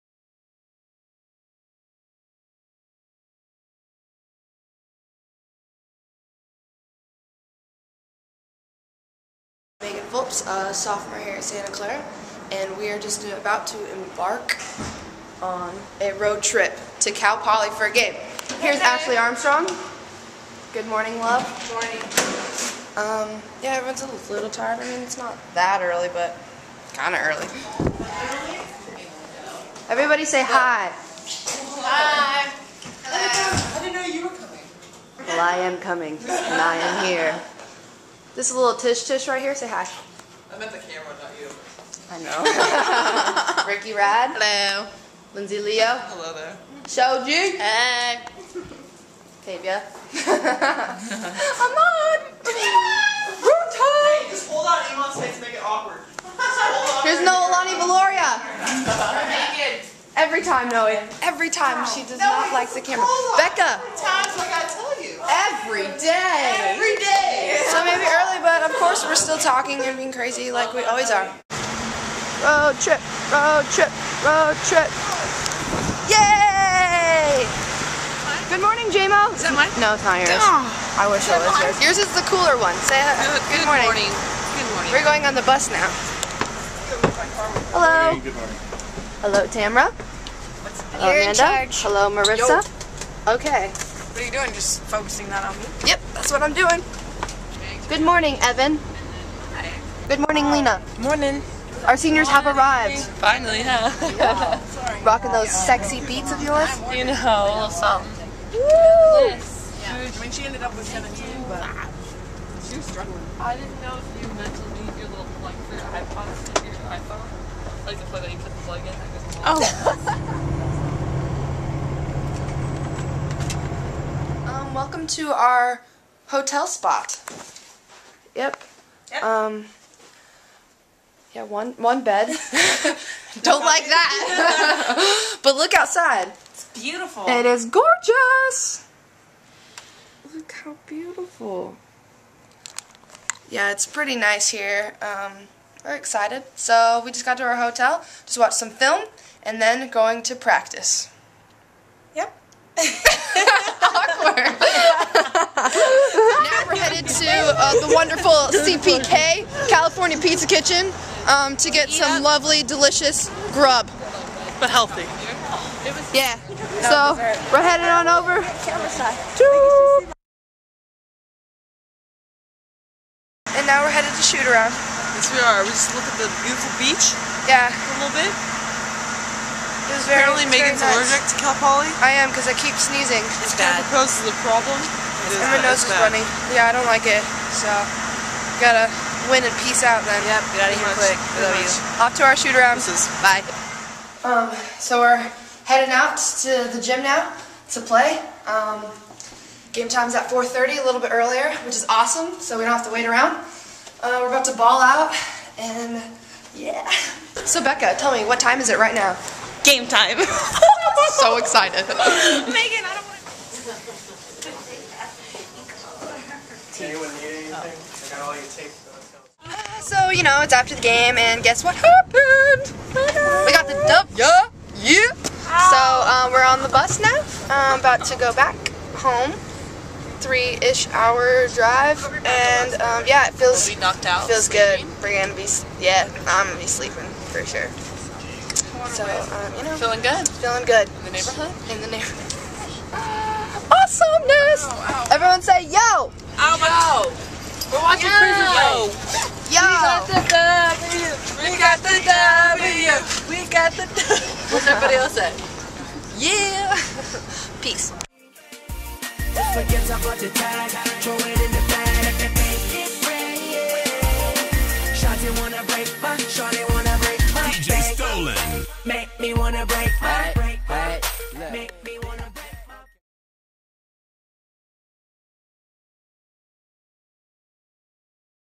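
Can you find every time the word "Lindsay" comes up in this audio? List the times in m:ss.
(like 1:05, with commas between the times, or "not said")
0:45.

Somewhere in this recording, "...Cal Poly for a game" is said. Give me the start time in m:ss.
0:17.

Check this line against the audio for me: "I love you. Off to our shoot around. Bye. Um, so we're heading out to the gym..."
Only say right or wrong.
right.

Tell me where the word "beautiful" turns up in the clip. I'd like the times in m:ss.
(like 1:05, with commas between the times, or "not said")
2:16, 2:20, 2:56.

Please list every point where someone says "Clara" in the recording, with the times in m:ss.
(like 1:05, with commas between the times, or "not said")
0:11.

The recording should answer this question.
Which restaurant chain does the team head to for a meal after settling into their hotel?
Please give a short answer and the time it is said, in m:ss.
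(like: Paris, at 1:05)
California Pizza Kitchen, at 2:39.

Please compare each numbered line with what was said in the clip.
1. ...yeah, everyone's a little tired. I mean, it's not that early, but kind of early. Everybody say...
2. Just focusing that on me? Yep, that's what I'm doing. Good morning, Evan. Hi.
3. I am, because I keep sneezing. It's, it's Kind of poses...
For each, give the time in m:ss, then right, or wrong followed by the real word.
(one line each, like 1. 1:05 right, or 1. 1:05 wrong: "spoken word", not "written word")
1. 0:23 right
2. 1:34 right
3. 3:01 right.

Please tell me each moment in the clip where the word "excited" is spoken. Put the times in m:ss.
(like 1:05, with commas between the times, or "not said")
2:25, 3:31.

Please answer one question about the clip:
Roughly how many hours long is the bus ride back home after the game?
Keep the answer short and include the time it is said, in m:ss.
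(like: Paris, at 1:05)
3, at 3:50.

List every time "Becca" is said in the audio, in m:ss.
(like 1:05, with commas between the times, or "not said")
1:03, 3:27.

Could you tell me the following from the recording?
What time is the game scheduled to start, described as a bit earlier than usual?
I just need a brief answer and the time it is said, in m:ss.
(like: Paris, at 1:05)
4:30, at 3:20.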